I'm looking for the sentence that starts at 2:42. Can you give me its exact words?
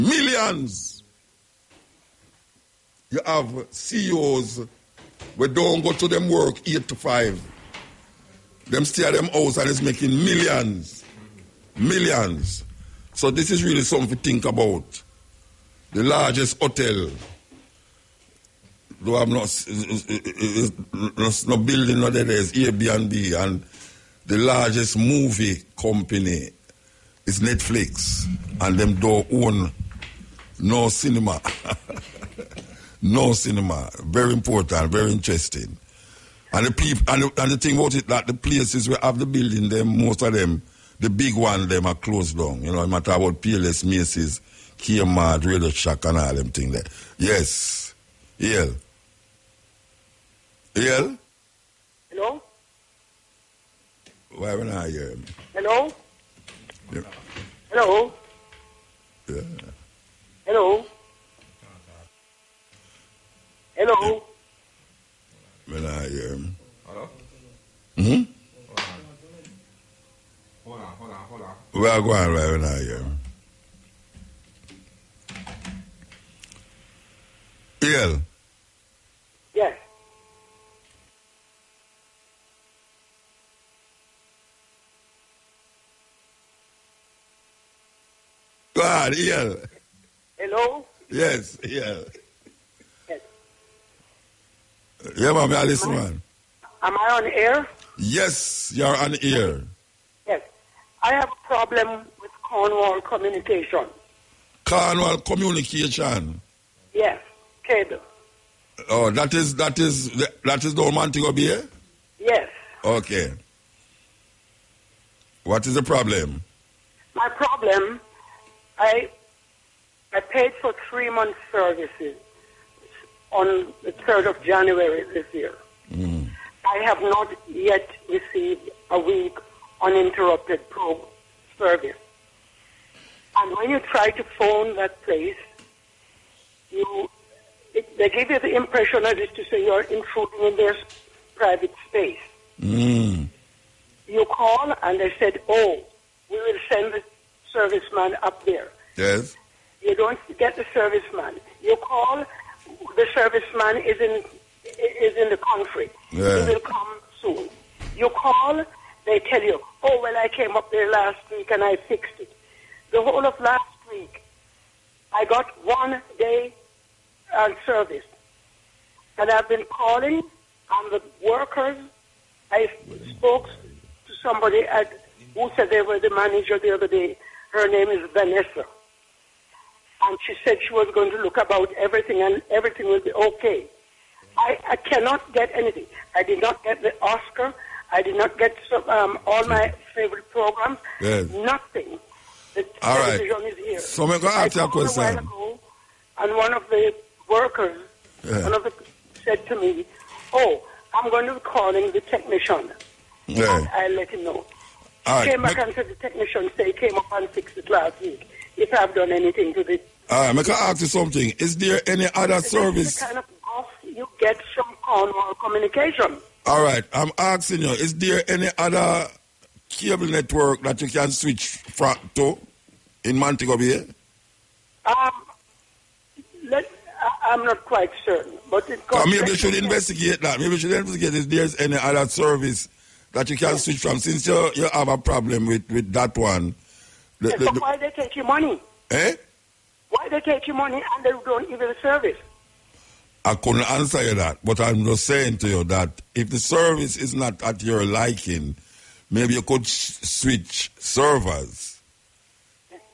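The whole of last week, I got one day uh, service, and I've been calling on the workers.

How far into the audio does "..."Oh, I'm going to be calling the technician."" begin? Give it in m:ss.
3:20.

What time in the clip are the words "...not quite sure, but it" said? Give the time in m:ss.
3:47.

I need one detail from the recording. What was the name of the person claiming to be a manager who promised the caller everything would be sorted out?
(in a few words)
Vanessa.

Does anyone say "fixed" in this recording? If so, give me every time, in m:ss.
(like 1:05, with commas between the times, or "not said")
2:41, 3:27.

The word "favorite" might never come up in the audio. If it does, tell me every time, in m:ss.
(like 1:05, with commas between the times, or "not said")
3:09.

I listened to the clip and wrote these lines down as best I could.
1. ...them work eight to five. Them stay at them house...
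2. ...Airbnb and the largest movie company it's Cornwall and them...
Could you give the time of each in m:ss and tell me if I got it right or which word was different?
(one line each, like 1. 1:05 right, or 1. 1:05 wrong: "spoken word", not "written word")
1. 0:06 right
2. 0:22 wrong: "Netflix", not "Cornwall".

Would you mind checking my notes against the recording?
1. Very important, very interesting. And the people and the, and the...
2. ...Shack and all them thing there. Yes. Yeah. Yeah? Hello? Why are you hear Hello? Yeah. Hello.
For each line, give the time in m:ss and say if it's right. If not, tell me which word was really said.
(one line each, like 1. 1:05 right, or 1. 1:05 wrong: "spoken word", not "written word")
1. 0:34 right
2. 0:45 right.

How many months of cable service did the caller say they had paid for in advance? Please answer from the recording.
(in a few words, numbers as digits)
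3.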